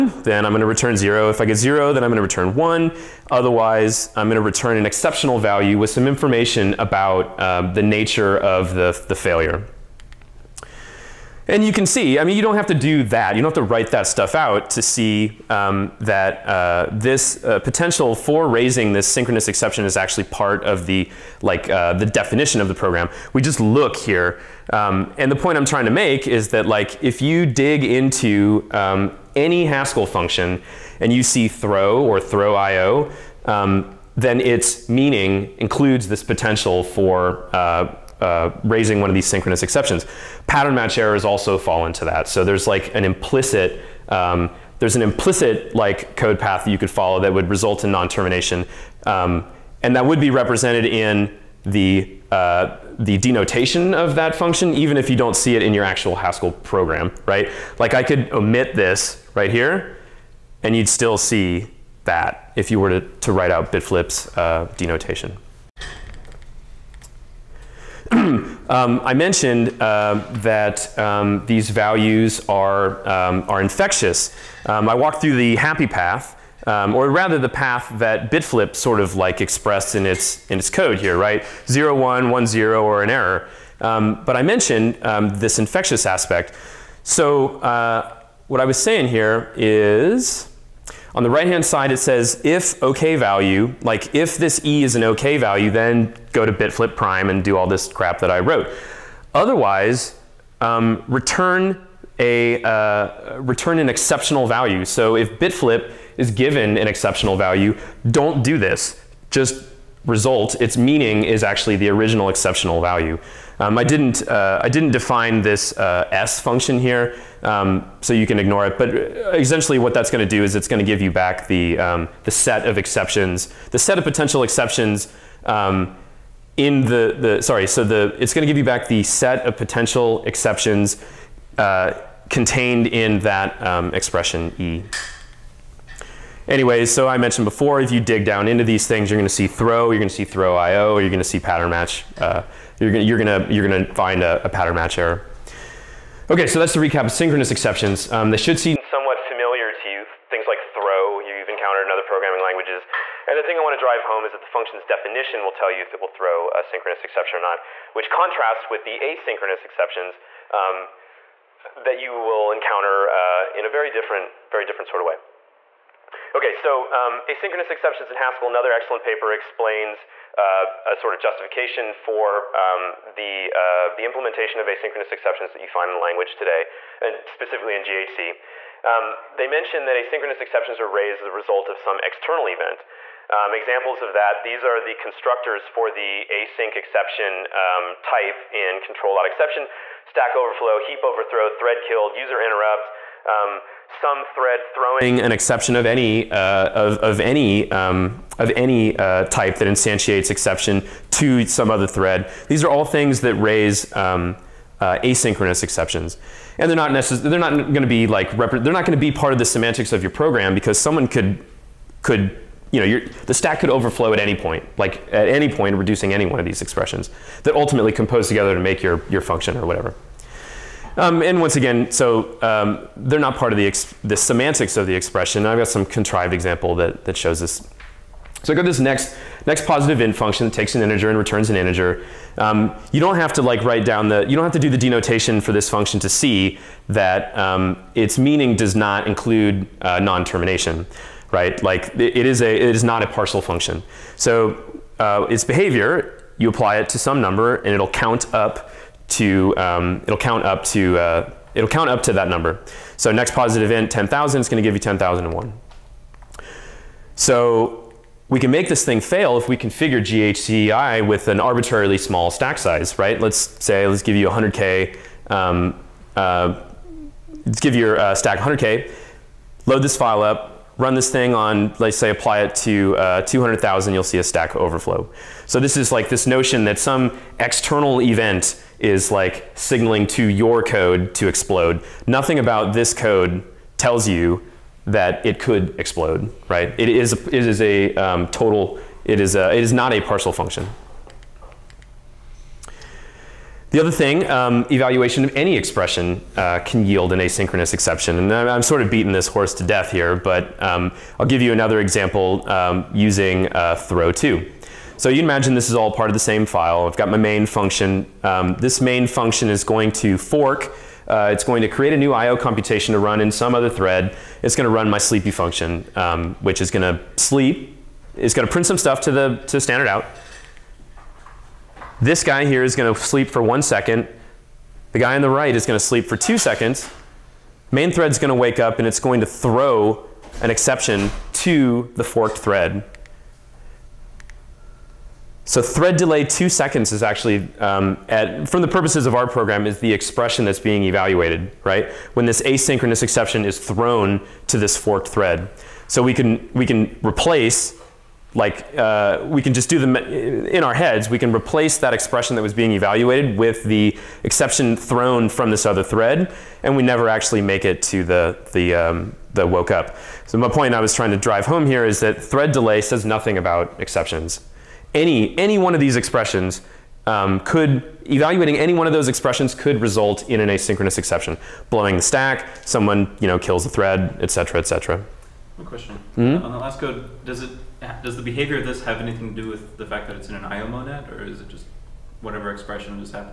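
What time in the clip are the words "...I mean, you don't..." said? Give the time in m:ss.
0:12.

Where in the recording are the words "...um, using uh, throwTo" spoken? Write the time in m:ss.
5:02.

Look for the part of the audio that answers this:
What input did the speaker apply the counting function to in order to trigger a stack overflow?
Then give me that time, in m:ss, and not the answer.
4:33.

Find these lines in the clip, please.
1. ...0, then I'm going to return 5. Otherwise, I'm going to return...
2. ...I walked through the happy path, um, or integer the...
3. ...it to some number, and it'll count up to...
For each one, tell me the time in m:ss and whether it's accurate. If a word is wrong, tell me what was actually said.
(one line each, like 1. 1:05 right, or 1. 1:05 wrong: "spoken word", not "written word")
1. 0:01 wrong: "1", not "5"
2. 1:14 wrong: "rather", not "integer"
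3. 4:06 right.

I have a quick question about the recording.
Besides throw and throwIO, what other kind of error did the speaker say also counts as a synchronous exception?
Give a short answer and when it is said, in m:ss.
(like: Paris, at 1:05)
Pattern match errors, at 0:40.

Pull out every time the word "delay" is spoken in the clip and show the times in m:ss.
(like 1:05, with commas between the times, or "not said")
5:35, 6:02.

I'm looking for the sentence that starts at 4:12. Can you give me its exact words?
So next positive int 10,000 is going to give you 10,001.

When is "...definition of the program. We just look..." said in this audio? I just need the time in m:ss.
0:22.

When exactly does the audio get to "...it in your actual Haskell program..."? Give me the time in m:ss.
0:55.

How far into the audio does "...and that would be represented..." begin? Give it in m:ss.
0:49.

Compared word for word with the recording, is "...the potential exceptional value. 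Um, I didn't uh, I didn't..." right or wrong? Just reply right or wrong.
wrong.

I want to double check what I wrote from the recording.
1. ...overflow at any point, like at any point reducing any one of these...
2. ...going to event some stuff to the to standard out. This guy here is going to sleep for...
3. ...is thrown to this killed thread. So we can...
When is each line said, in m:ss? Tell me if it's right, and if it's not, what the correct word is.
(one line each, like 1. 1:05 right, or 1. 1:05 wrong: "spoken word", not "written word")
1. 3:33 right
2. 5:18 wrong: "print", not "event"
3. 5:43 wrong: "forked", not "killed".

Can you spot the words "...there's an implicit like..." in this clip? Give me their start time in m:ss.
0:44.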